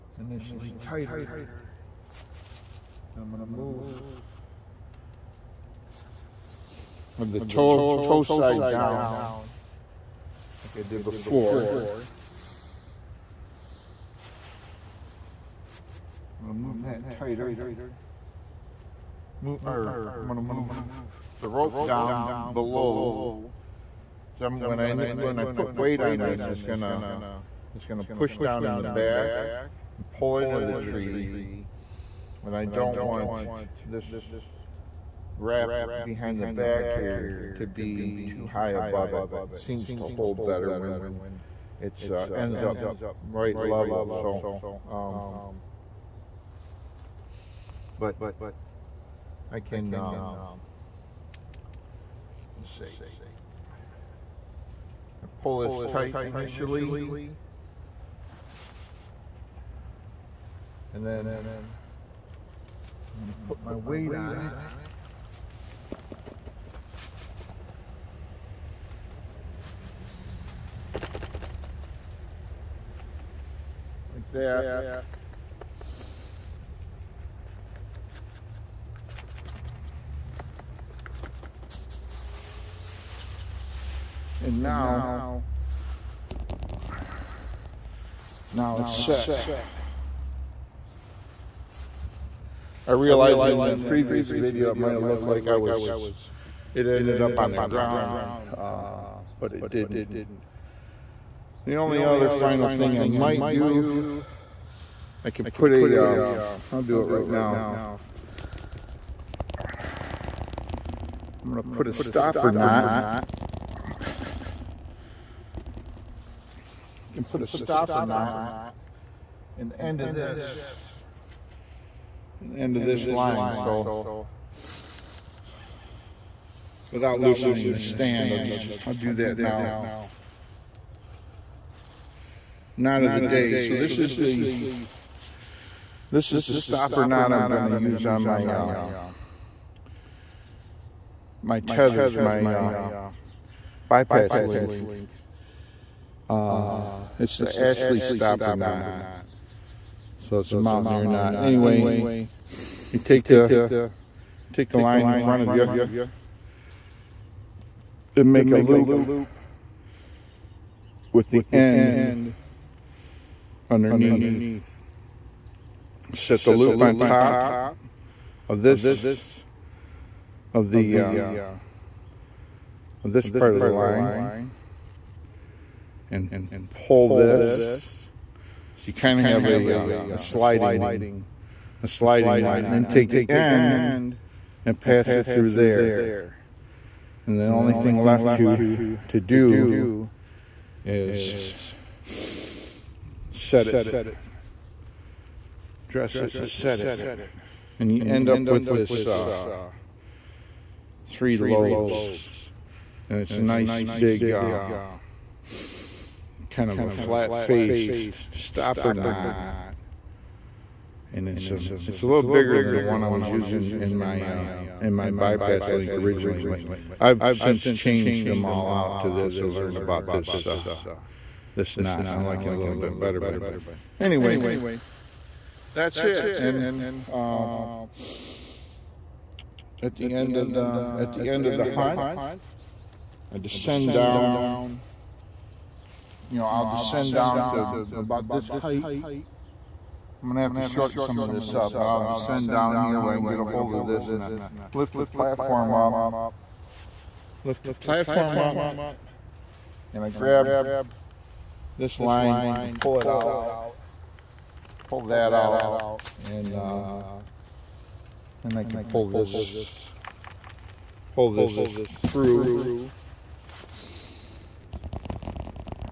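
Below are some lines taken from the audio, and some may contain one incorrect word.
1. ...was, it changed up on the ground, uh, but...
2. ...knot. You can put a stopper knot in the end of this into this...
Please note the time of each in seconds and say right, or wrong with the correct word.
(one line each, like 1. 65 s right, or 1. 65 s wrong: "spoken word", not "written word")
1. 95 s wrong: "ended", not "changed"
2. 112 s right.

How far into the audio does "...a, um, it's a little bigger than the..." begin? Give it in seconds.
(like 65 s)
211 s.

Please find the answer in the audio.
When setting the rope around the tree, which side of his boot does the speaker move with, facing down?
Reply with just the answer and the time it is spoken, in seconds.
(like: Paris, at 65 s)
toe side, at 8 s.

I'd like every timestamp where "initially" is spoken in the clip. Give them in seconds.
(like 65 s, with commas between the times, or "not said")
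0 s, 56 s.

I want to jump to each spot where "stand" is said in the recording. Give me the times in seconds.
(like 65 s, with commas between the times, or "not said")
127 s.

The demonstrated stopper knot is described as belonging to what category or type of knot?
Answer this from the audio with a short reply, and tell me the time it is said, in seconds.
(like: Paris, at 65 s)
mountaineer knot, at 150 s.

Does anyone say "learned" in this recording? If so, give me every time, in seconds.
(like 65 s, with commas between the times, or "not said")
219 s.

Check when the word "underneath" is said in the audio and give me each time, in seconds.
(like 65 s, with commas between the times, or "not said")
163 s.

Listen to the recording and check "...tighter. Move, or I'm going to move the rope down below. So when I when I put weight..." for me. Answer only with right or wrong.
right.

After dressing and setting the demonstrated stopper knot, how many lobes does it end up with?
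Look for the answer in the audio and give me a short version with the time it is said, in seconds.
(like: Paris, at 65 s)
3, at 201 s.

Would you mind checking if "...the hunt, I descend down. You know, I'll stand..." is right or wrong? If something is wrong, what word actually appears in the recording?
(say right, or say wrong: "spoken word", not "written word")
wrong: "descend", not "stand".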